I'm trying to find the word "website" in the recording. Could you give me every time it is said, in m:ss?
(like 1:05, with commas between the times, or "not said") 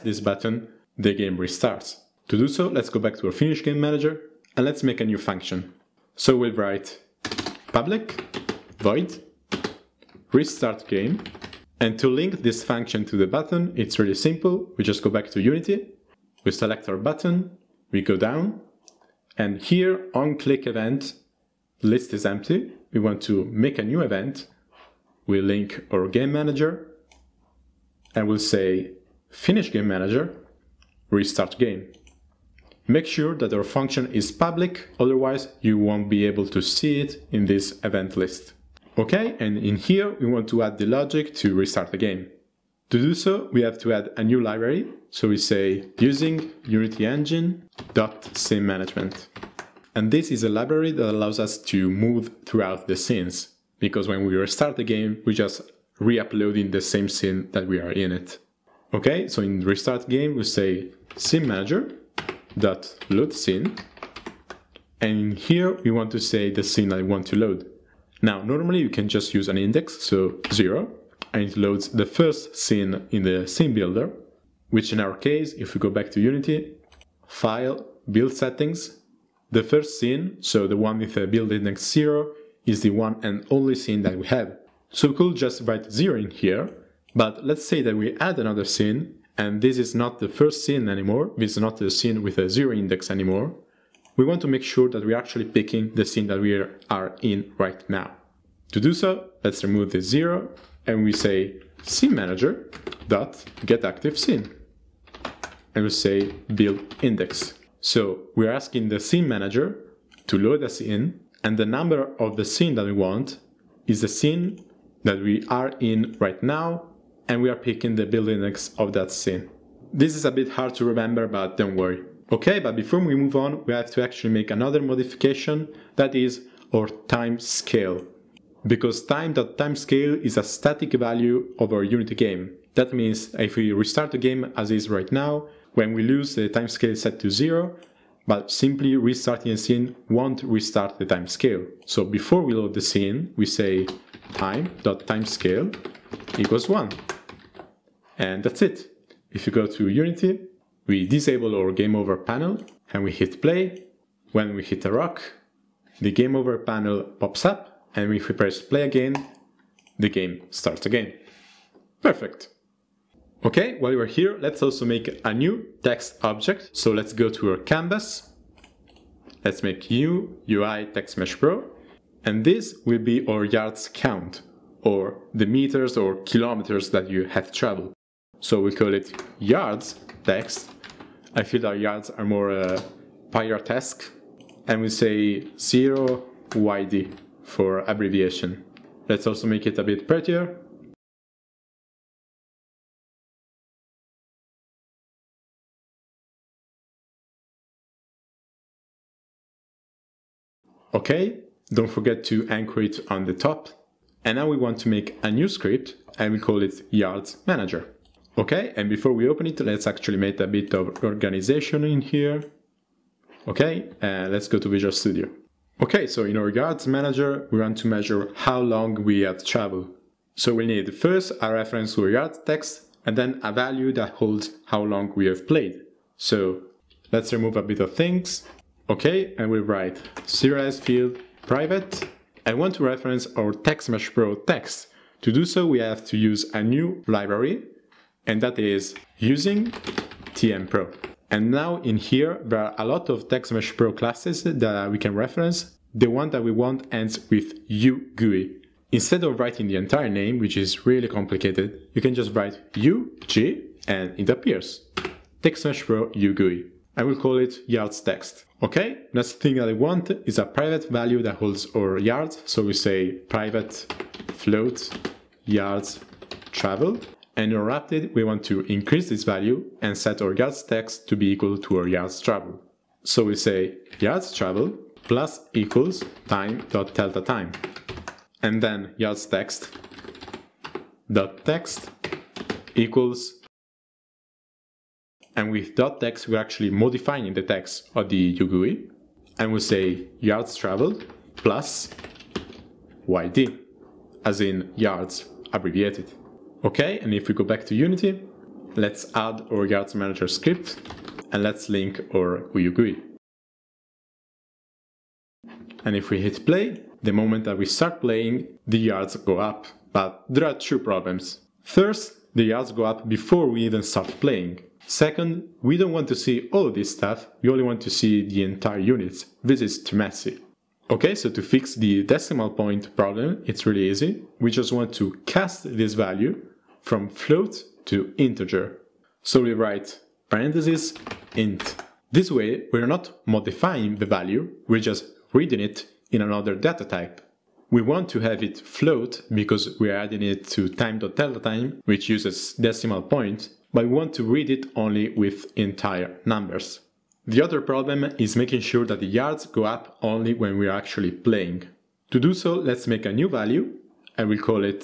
not said.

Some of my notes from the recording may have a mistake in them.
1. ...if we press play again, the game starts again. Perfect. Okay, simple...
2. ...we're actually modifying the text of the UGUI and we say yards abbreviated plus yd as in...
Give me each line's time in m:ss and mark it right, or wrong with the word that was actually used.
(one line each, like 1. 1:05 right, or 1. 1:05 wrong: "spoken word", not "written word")
1. 2:38 wrong: "while", not "simple"
2. 4:46 wrong: "traveled", not "abbreviated".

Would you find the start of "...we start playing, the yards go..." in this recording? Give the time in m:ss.
5:07.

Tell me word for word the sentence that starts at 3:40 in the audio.
So we need first a reference to yard text and then a value that holds how long we have played.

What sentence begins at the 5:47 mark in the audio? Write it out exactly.
The other problem is making sure that the yards go up only when we're actually playing.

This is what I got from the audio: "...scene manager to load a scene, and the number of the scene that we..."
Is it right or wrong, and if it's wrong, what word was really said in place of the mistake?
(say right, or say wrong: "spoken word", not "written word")
right.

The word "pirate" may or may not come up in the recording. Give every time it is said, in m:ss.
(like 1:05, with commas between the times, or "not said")
3:03.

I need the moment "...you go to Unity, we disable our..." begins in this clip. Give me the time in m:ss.
2:29.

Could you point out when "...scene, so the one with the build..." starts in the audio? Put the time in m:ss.
1:19.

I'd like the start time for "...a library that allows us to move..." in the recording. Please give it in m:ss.
0:50.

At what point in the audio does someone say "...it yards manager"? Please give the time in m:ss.
3:26.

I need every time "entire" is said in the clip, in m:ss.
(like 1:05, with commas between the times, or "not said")
4:09, 5:18, 5:45.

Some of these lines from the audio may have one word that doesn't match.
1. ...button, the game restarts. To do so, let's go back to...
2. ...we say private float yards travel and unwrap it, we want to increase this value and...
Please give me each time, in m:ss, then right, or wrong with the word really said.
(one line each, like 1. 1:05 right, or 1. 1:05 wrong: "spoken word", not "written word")
1. 0:00 right
2. 4:22 right.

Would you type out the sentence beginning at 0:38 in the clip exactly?
Okay, and in here we want to add the logic to restart the game.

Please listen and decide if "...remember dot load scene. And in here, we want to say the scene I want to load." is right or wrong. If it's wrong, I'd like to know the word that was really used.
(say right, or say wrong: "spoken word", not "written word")
wrong: "manager", not "remember".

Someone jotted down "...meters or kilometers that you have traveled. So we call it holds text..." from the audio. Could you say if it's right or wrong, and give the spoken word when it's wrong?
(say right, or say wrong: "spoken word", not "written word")
wrong: "yards", not "holds".